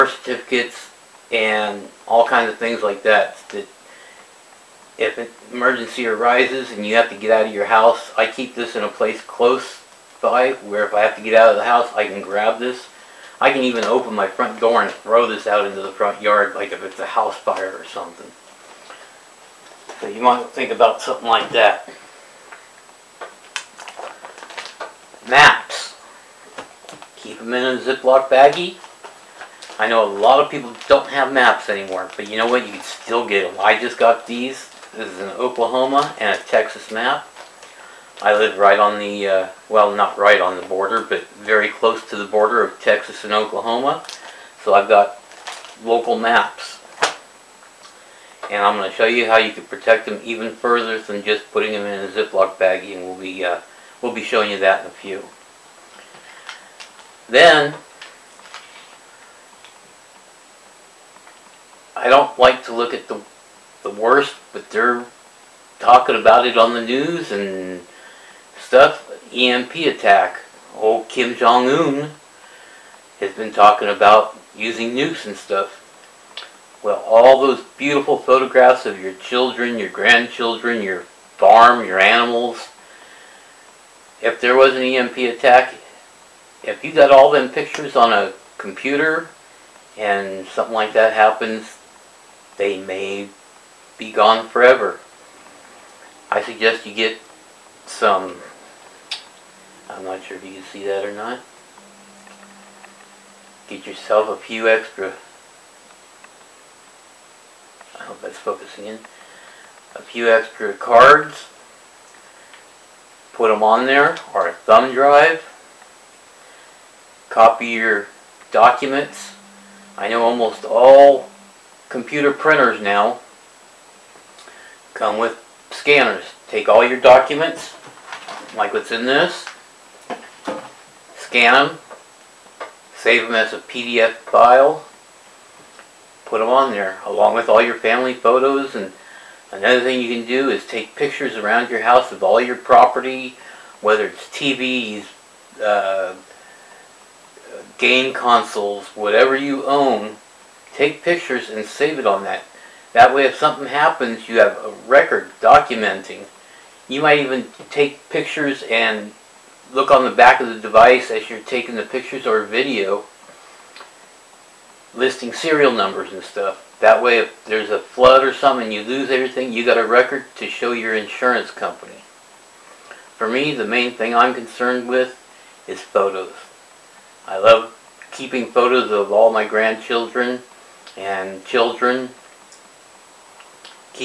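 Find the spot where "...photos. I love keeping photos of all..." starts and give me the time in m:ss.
2:55.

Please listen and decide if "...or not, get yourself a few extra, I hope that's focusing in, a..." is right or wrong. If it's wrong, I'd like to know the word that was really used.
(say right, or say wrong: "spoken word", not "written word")
right.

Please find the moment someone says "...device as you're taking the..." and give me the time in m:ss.
2:40.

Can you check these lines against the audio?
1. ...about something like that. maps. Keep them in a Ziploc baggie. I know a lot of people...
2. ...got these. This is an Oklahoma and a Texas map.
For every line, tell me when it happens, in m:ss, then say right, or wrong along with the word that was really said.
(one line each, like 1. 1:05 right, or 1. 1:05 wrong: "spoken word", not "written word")
1. 0:20 right
2. 0:33 right.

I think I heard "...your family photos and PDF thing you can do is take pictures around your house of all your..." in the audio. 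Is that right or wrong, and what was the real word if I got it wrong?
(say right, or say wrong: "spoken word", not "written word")
wrong: "Another", not "PDF".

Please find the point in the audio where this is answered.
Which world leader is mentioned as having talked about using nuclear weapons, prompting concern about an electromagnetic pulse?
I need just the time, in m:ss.
1:11.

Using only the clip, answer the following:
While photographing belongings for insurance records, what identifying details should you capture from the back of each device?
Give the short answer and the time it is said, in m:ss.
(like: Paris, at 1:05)
Serial numbers, at 2:45.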